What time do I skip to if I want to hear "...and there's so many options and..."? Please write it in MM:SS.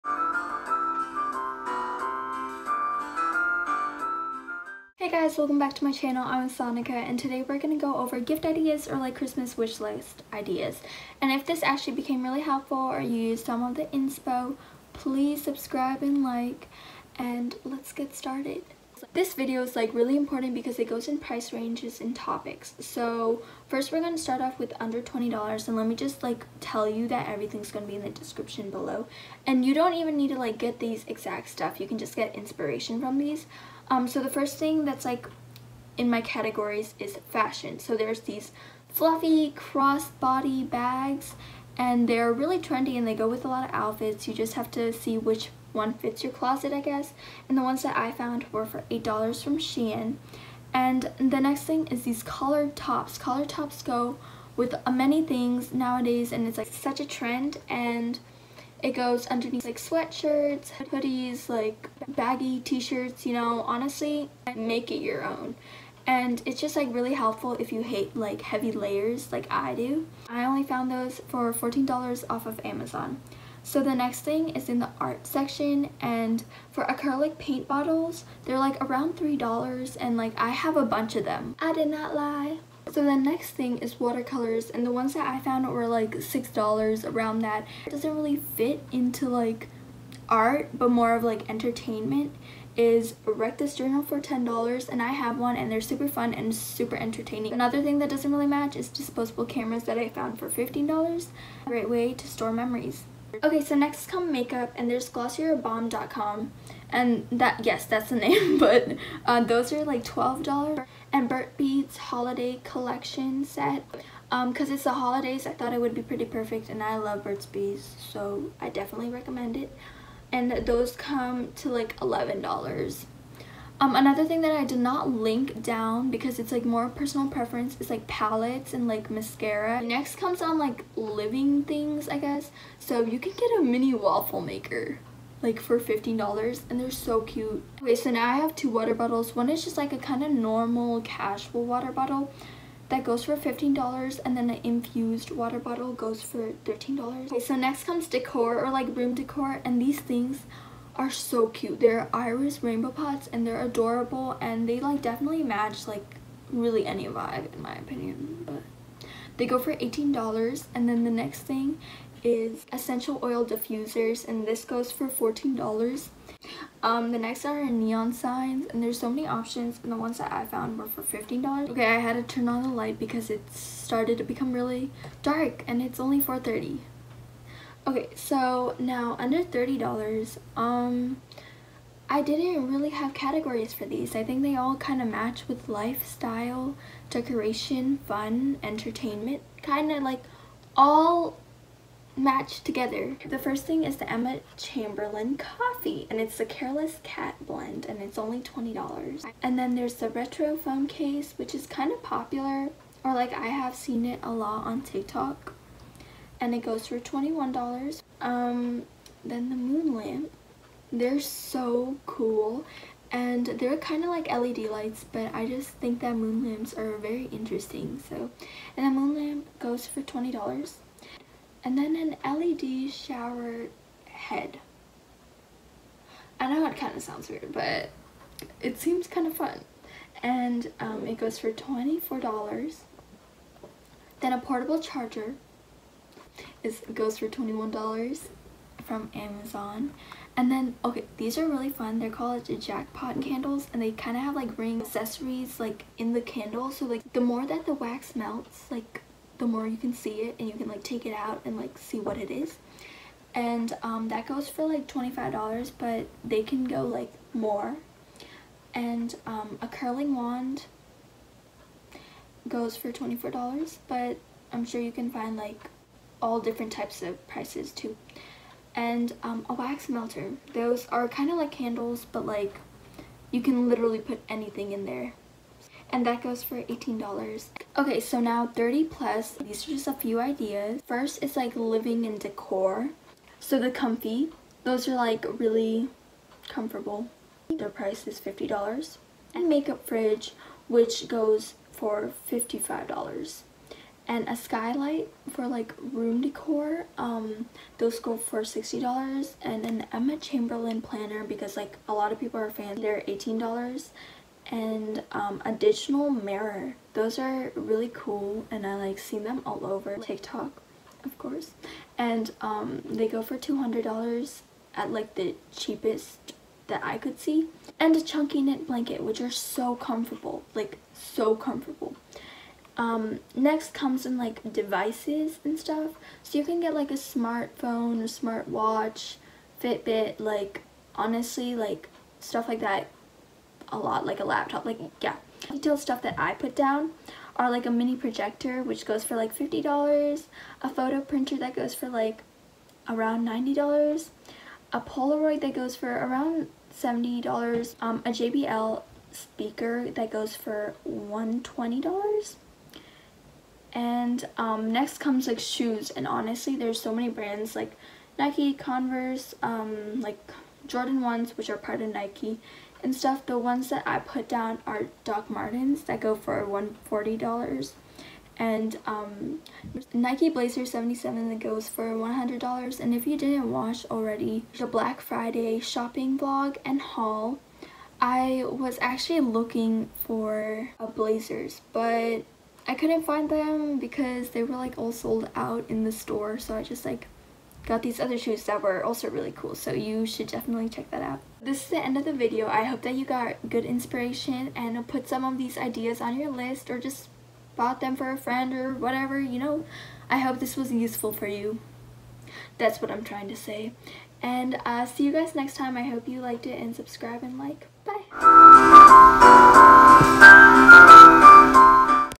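02:48.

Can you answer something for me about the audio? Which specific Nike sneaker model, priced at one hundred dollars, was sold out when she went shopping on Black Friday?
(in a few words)
Nike Blazer 77.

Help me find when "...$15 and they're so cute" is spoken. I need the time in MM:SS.
02:15.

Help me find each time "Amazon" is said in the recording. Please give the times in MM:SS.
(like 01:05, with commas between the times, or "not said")
01:12, 03:59.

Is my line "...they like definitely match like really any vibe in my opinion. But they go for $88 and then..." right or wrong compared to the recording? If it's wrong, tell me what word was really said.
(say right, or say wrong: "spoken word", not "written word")
wrong: "18", not "88".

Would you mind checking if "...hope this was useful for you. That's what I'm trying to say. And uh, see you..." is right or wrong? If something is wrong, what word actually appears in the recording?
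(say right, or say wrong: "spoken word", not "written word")
right.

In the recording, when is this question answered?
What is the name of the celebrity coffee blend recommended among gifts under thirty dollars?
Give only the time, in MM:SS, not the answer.
03:16.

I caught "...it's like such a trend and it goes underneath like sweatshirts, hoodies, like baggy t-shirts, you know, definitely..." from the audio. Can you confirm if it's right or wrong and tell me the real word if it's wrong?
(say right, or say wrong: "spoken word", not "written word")
wrong: "honestly", not "definitely".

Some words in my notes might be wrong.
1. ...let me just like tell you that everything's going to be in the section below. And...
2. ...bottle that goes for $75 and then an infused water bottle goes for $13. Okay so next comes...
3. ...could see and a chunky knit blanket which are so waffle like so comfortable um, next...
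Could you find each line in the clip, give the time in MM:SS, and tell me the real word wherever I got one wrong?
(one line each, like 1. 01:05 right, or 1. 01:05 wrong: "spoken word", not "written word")
1. 00:25 wrong: "description", not "section"
2. 02:21 wrong: "15", not "75"
3. 05:16 wrong: "comfortable", not "waffle".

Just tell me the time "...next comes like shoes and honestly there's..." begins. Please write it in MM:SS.
05:54.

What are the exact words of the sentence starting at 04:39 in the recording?
These are just a few ideas.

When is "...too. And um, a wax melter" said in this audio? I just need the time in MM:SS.
04:27.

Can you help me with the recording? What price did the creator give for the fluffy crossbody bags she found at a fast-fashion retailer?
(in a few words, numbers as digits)
$8.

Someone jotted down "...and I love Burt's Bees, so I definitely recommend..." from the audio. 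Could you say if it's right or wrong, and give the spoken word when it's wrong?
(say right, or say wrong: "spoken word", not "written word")
right.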